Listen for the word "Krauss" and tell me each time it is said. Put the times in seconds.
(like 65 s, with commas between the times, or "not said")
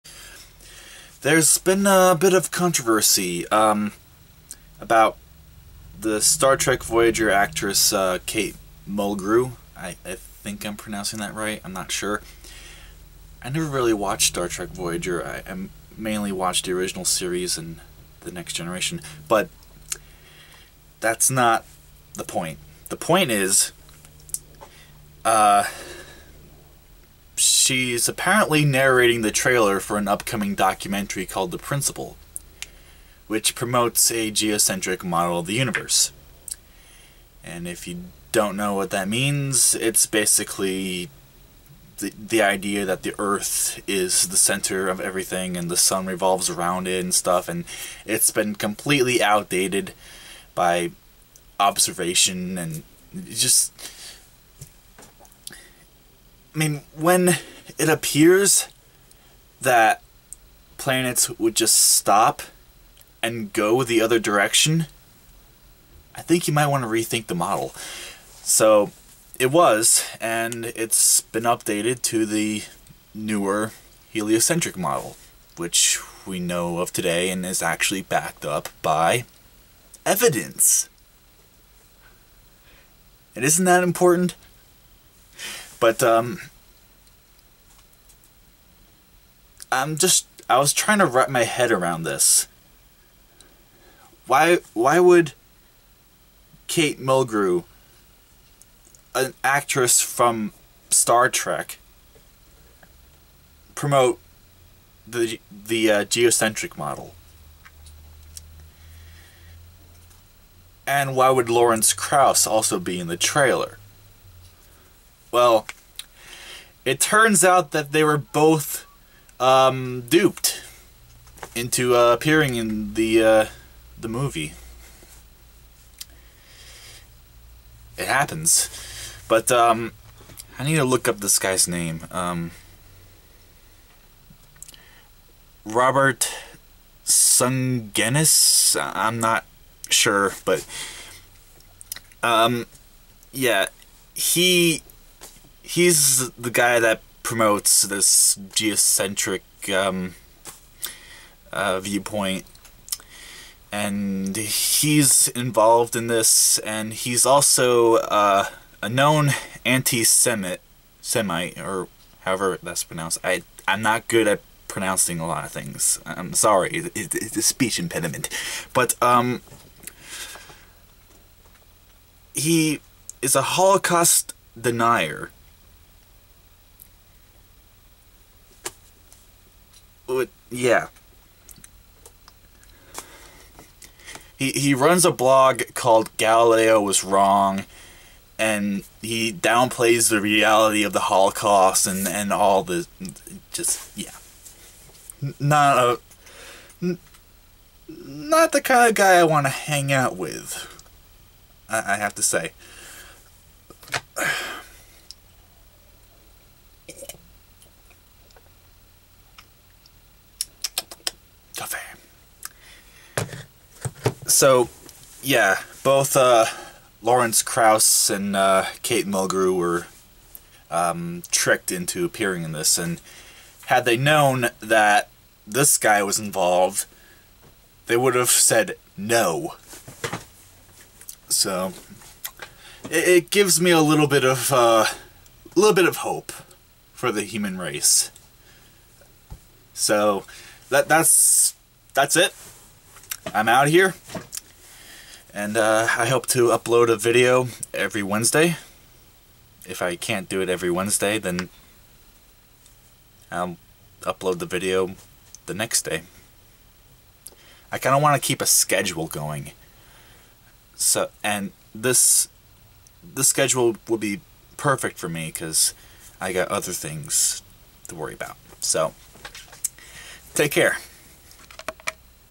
111 s, 217 s.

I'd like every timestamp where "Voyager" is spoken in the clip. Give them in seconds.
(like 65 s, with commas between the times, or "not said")
6 s, 14 s.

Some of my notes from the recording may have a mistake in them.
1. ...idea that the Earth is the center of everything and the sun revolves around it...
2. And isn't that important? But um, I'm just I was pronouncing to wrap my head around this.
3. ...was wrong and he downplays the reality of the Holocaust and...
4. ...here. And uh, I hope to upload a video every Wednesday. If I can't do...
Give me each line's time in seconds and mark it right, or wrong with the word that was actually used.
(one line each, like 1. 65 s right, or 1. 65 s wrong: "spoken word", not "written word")
1. 42 s right
2. 83 s wrong: "trying", not "pronouncing"
3. 186 s right
4. 243 s right.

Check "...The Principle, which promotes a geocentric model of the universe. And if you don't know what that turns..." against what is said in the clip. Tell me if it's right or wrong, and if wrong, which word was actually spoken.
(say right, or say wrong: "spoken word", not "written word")
wrong: "means", not "turns".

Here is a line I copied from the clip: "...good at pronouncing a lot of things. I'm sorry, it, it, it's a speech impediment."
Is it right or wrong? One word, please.
right.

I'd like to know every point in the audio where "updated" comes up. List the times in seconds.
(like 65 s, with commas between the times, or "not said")
71 s.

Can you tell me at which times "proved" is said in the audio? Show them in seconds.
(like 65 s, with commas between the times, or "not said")
not said.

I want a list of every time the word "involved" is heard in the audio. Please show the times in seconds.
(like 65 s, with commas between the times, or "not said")
155 s, 226 s.